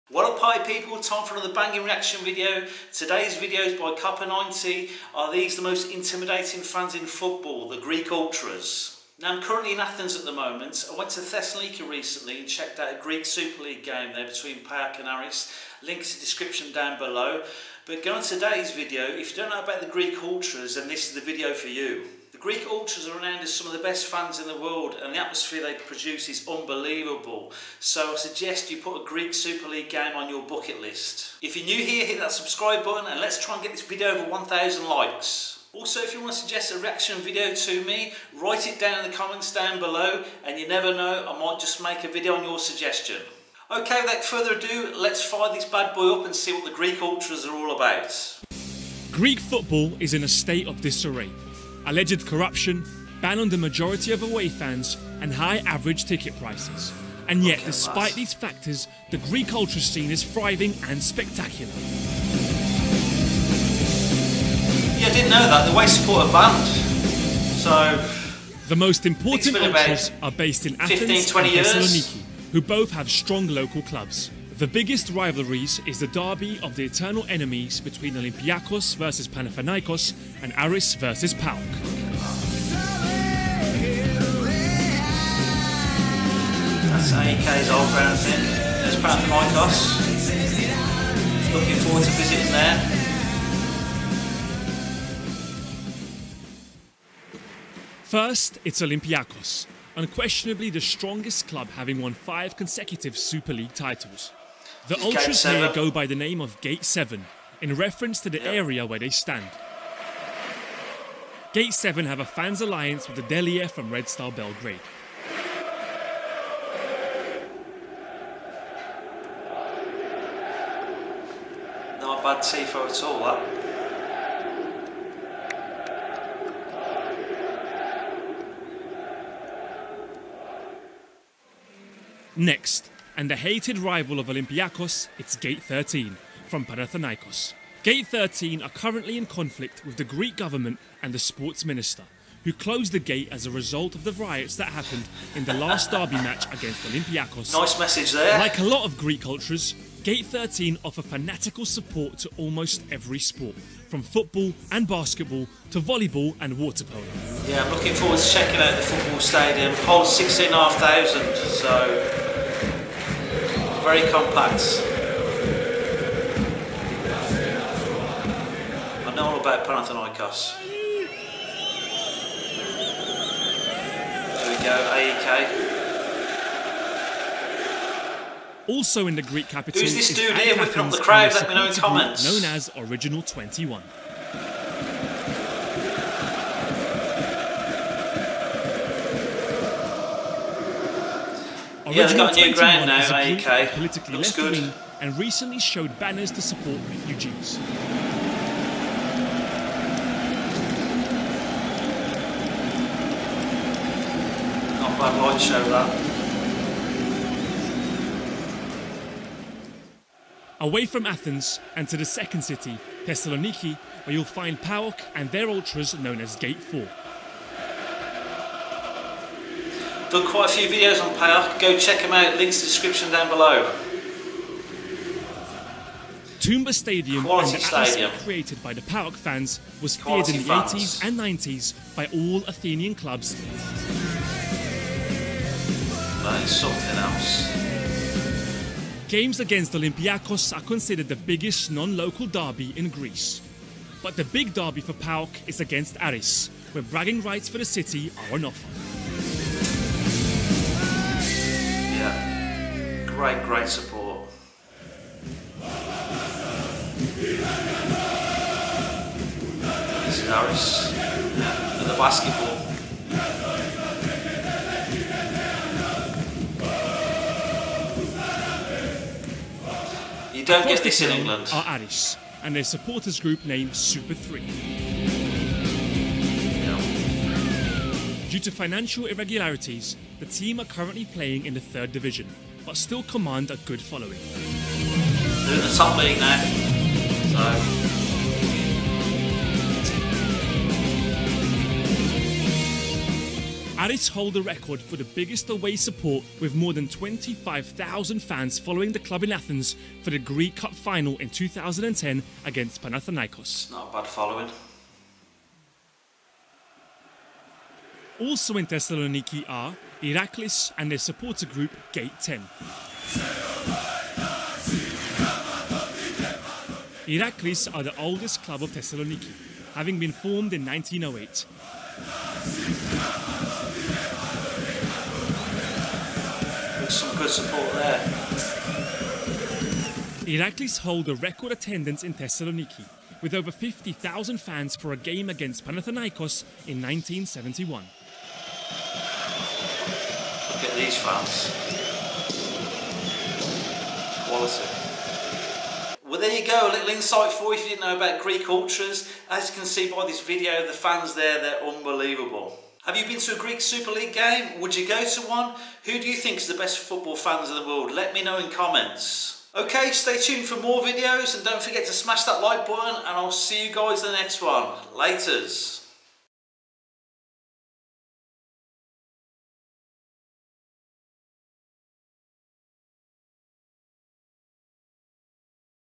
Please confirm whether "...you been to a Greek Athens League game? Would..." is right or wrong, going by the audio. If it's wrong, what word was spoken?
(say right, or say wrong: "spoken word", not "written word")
wrong: "Super", not "Athens".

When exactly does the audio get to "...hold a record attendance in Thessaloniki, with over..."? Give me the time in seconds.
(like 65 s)
330 s.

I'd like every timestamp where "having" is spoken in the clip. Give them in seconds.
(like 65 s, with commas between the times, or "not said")
101 s, 319 s.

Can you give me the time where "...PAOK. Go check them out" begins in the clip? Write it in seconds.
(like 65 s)
221 s.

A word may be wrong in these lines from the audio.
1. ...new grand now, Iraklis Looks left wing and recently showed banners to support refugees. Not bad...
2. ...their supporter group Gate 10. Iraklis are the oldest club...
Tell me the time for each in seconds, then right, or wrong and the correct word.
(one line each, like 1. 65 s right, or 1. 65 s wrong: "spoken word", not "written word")
1. 192 s wrong: "Politically", not "Iraklis"
2. 310 s right.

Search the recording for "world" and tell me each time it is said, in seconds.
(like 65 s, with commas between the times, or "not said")
24 s, 357 s.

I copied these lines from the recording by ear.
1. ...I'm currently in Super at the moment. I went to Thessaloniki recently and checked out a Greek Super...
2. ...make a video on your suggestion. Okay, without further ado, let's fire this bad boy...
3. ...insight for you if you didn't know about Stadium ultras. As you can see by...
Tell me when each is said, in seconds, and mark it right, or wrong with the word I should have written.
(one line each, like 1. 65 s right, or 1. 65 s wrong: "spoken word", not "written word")
1. 9 s wrong: "Athens", not "Super"
2. 41 s right
3. 346 s wrong: "Greek", not "Stadium".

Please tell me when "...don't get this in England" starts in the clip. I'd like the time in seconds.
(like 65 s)
270 s.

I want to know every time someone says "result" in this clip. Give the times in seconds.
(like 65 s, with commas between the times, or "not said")
143 s.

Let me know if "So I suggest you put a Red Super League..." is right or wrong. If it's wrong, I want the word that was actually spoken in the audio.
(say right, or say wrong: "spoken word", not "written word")
wrong: "Greek", not "Red".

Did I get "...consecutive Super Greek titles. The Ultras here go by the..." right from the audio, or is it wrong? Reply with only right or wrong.
wrong.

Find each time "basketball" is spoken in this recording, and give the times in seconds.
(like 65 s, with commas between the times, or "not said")
154 s, 261 s.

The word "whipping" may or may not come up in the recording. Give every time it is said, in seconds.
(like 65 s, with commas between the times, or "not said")
180 s.